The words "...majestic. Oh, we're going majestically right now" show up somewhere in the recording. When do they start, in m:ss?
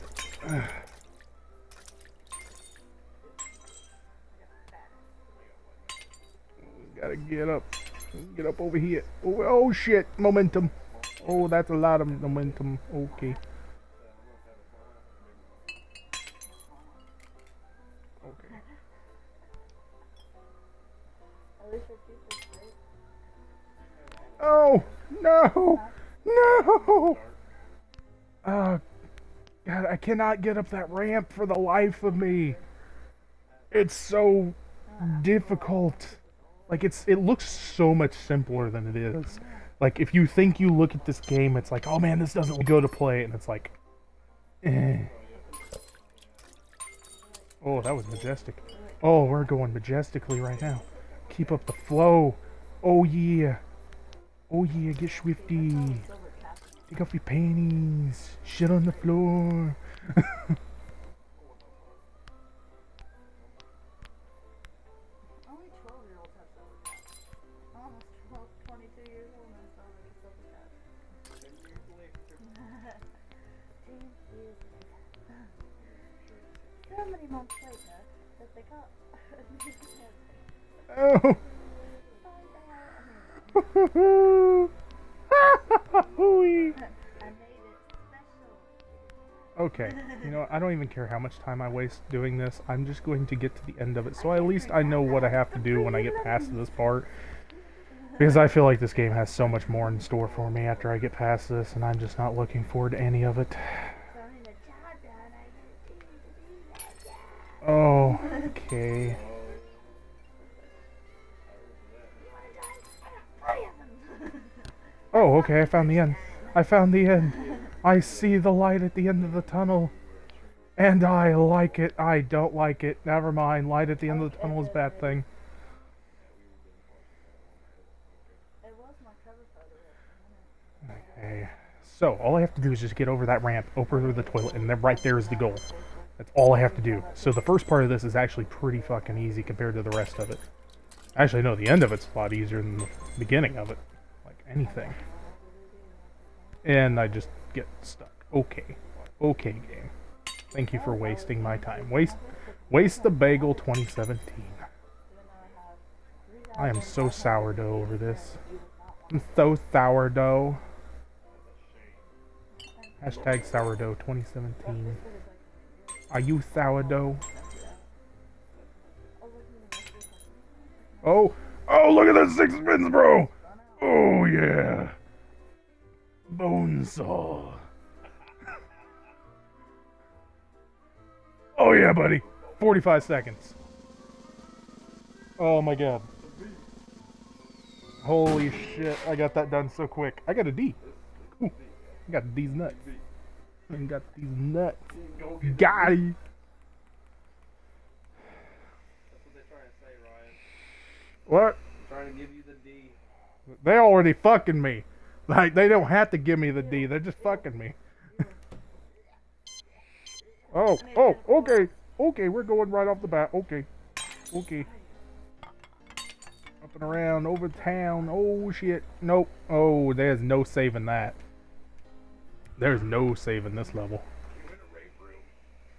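0:48.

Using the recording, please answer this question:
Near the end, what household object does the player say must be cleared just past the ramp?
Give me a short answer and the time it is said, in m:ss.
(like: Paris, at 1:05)
toilet, at 2:14.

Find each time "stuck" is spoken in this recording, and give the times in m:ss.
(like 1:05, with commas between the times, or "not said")
2:27.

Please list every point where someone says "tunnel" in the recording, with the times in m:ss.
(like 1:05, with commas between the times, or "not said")
1:59, 2:04.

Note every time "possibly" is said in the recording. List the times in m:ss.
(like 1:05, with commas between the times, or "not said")
not said.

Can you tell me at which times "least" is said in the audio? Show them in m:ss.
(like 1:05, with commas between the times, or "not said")
1:34.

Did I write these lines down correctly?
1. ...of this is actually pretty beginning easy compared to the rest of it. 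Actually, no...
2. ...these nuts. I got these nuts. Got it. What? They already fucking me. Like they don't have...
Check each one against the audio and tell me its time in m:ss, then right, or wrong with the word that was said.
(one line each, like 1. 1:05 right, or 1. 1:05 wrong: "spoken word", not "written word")
1. 2:17 wrong: "fucking", not "beginning"
2. 3:12 right.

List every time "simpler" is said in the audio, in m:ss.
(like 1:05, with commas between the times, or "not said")
0:38.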